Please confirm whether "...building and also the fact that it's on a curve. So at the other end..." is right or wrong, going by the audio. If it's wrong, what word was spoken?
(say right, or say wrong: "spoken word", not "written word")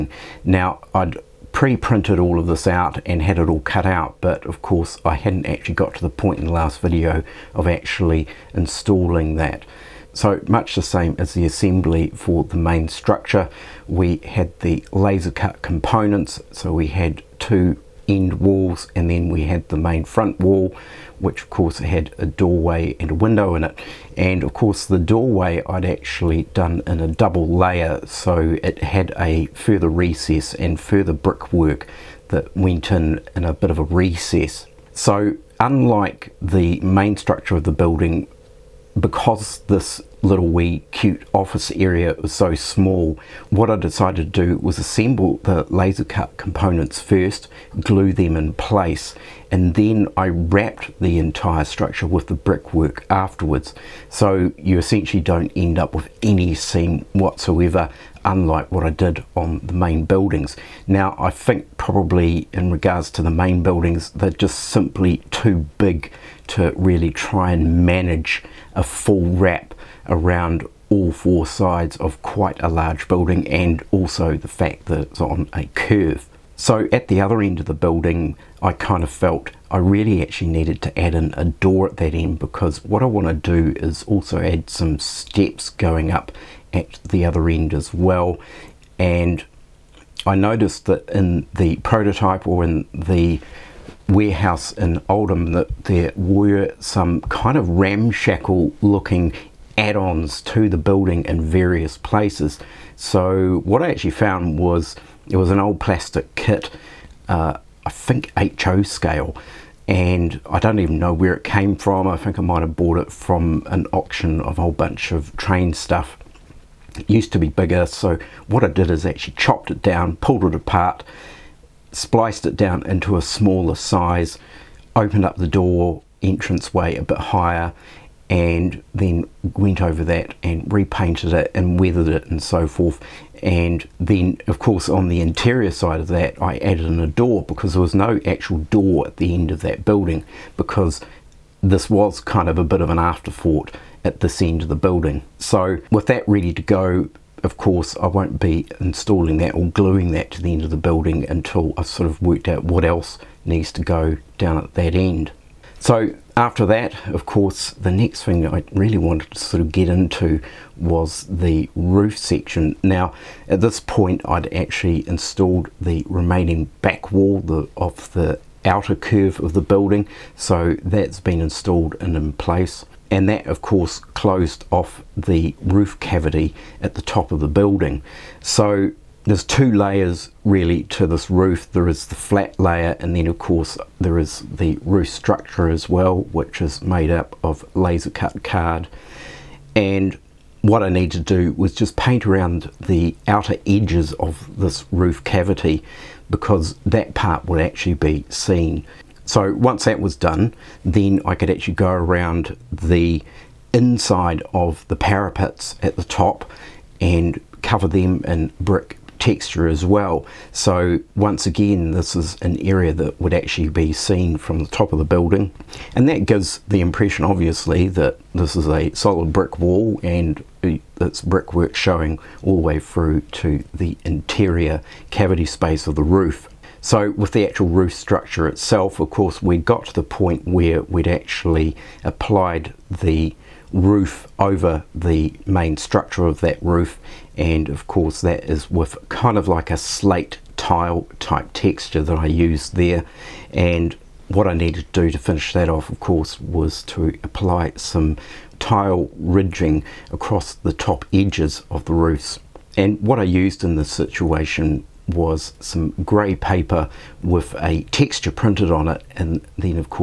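right.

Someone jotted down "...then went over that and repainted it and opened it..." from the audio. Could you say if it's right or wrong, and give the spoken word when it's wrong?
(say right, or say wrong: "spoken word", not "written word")
wrong: "weathered", not "opened".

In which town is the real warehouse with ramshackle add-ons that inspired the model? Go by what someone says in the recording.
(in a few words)
Oldham.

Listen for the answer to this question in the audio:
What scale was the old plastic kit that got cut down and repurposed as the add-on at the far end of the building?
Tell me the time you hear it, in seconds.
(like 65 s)
108 s.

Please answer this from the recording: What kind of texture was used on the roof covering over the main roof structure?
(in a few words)
Slate tile.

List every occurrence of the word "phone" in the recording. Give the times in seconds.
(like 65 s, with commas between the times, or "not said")
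not said.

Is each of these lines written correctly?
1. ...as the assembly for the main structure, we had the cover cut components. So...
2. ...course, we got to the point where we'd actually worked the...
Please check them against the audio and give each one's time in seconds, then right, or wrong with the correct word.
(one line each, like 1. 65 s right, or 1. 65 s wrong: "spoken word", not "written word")
1. 11 s wrong: "laser", not "cover"
2. 229 s wrong: "applied", not "worked".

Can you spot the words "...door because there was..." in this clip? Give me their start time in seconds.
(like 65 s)
137 s.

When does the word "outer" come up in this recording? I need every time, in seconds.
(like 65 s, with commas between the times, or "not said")
168 s, 193 s.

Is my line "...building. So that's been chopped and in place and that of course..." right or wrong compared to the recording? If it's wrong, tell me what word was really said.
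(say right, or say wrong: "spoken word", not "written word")
wrong: "installed", not "chopped".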